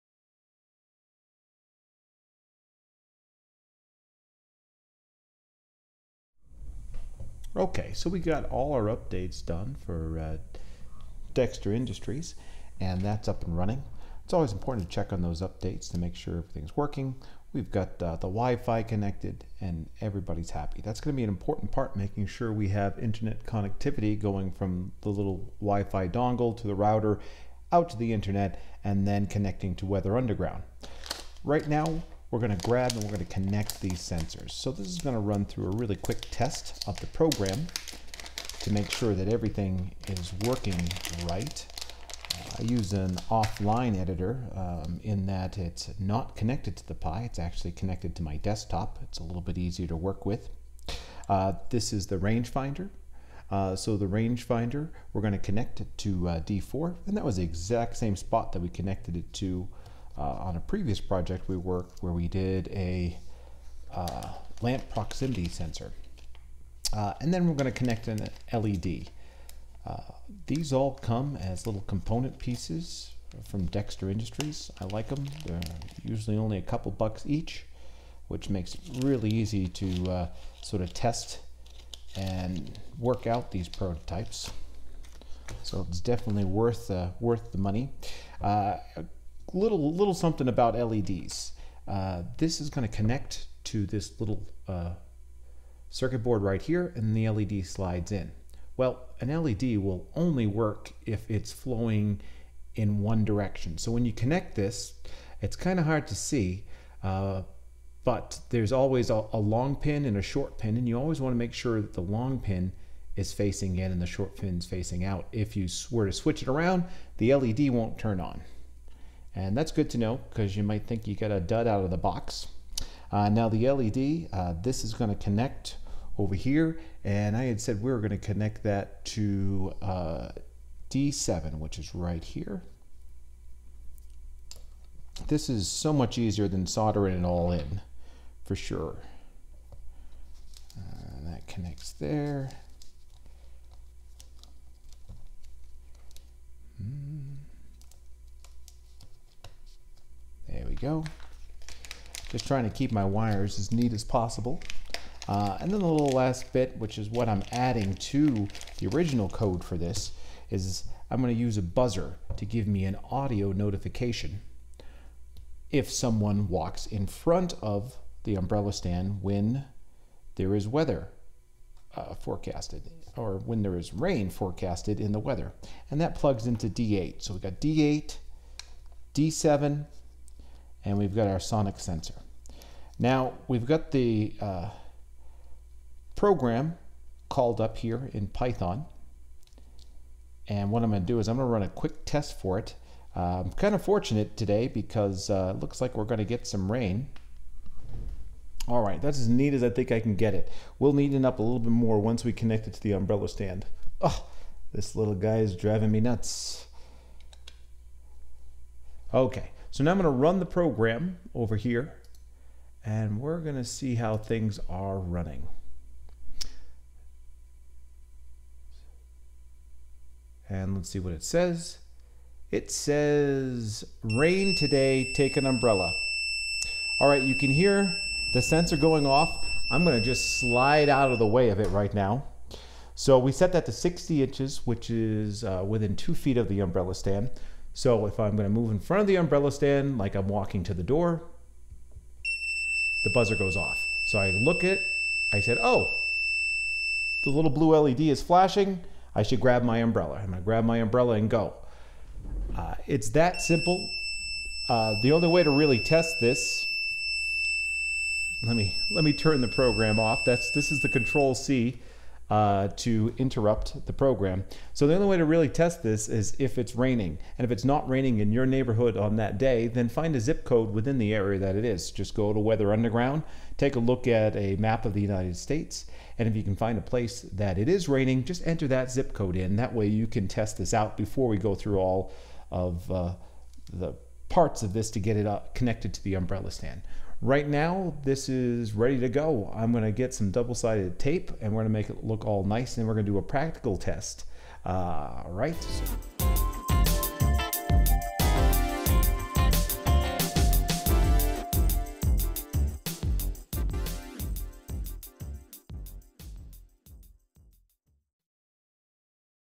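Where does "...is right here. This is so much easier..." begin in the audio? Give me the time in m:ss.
2:11.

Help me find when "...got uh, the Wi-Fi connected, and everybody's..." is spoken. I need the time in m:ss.
0:17.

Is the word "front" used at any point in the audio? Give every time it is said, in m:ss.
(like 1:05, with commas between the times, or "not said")
2:47, 3:58.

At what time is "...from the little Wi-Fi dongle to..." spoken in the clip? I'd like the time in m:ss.
0:24.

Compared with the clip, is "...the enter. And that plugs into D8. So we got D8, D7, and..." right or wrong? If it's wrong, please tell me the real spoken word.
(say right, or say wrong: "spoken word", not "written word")
wrong: "weather", not "enter".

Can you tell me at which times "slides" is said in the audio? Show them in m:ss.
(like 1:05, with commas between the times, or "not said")
1:37, 3:50.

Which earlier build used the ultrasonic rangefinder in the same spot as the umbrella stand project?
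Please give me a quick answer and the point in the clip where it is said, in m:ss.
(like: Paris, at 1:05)
lamp proximity sensor, at 1:04.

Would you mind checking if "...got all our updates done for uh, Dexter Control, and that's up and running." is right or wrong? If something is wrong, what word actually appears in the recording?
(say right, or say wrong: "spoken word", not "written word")
wrong: "Industries", not "Control".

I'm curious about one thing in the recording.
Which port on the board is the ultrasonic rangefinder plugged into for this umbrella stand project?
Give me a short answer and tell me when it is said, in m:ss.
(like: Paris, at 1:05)
D4, at 0:56.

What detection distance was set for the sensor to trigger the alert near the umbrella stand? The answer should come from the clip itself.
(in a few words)
60 inches.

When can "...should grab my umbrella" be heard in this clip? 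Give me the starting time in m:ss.
4:09.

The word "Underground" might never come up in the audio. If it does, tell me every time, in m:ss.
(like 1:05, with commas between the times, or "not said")
0:30, 4:32.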